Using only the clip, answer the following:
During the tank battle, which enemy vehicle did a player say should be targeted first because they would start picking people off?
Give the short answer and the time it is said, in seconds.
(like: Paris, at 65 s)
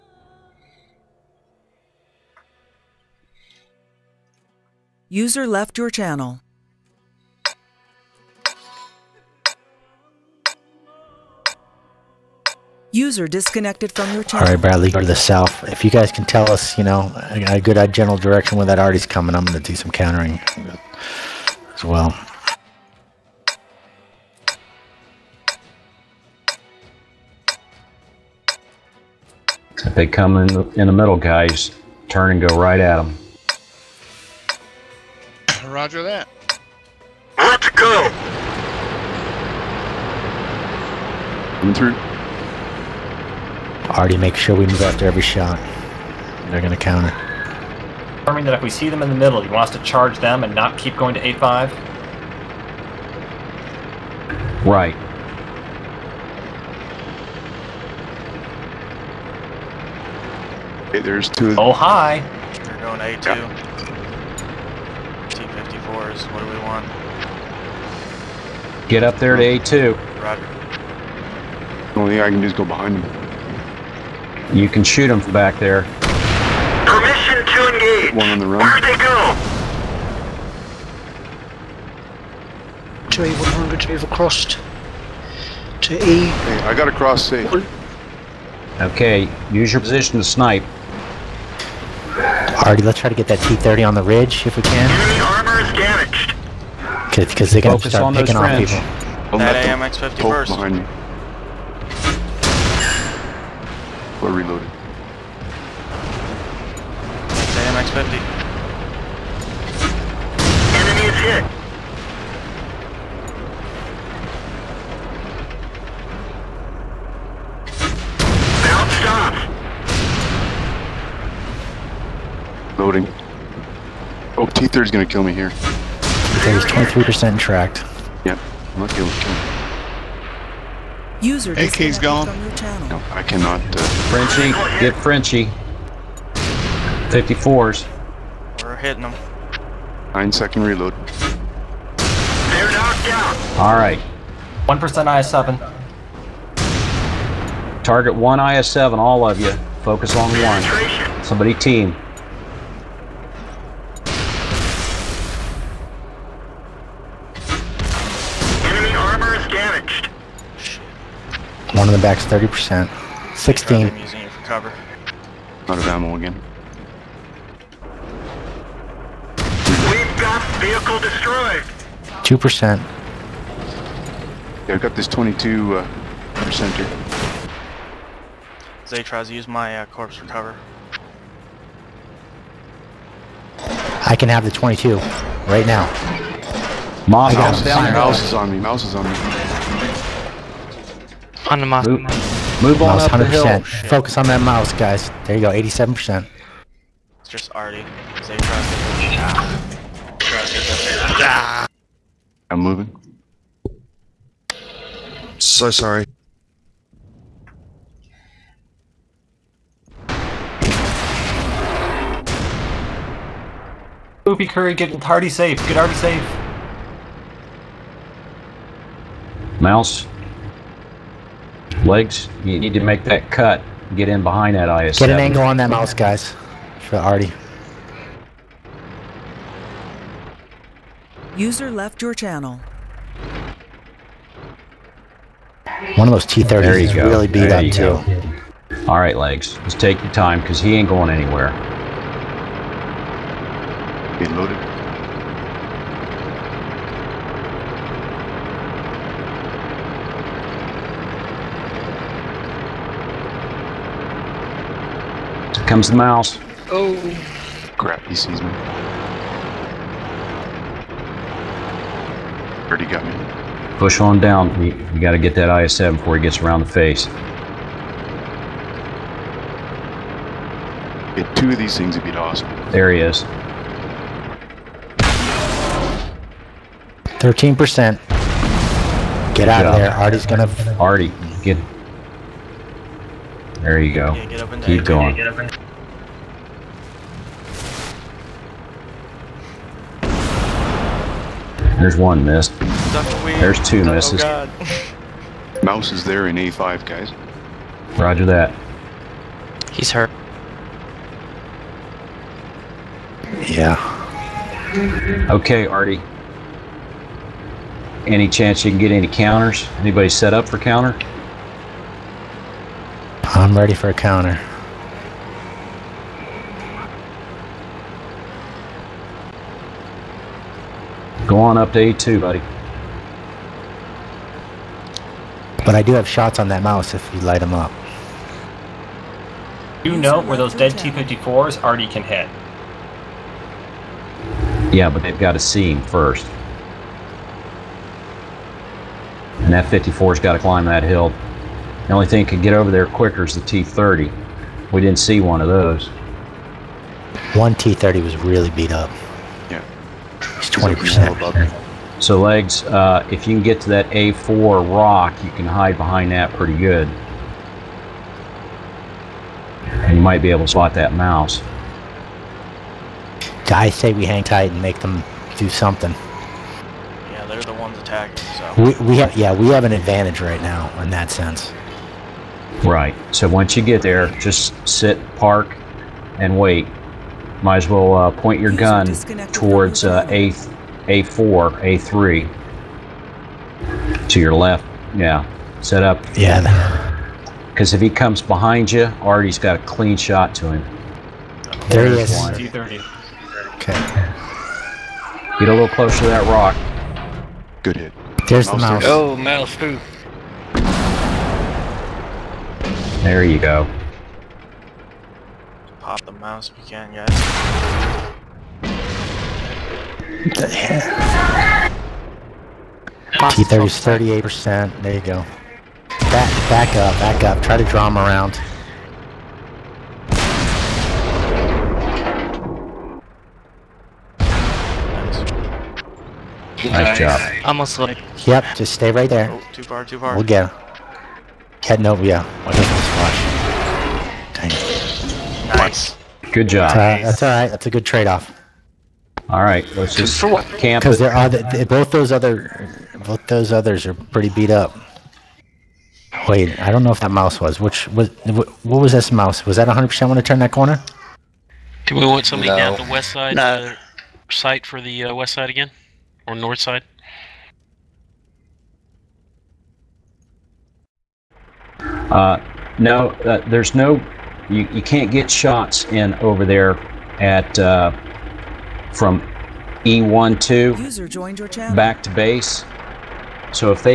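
AMX 50, at 99 s.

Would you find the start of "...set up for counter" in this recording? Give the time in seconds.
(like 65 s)
310 s.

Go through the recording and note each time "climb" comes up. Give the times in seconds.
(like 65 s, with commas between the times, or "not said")
340 s.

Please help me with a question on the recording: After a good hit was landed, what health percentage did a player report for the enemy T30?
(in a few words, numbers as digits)
38%.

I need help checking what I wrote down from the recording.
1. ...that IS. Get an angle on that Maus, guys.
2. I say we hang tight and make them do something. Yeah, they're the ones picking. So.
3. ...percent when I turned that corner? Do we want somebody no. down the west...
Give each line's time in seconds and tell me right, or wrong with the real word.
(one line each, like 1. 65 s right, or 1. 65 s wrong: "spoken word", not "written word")
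1. 224 s right
2. 363 s wrong: "attacking", not "picking"
3. 449 s right.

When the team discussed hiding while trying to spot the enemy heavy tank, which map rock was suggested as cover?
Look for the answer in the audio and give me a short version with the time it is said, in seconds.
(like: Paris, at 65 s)
A4 rock, at 353 s.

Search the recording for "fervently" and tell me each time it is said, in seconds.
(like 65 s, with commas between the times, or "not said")
not said.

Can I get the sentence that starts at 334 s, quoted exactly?
Yeah, but they've got to see him first.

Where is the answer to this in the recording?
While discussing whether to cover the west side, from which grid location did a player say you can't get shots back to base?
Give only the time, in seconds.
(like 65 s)
469 s.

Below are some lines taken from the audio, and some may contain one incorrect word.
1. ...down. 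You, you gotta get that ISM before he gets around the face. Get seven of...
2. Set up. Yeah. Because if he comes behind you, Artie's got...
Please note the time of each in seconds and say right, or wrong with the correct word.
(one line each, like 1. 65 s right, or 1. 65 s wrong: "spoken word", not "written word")
1. 264 s wrong: "two", not "seven"
2. 385 s right.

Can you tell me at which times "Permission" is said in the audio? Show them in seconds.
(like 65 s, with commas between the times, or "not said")
76 s.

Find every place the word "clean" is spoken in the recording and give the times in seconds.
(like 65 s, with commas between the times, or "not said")
389 s.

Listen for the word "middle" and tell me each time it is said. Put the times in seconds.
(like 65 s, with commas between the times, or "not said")
30 s, 49 s.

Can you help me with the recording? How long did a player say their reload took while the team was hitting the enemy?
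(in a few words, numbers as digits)
9 seconds.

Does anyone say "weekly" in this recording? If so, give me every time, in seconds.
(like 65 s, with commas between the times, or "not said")
not said.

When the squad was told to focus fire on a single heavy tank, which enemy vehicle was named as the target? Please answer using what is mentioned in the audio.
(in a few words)
IS7.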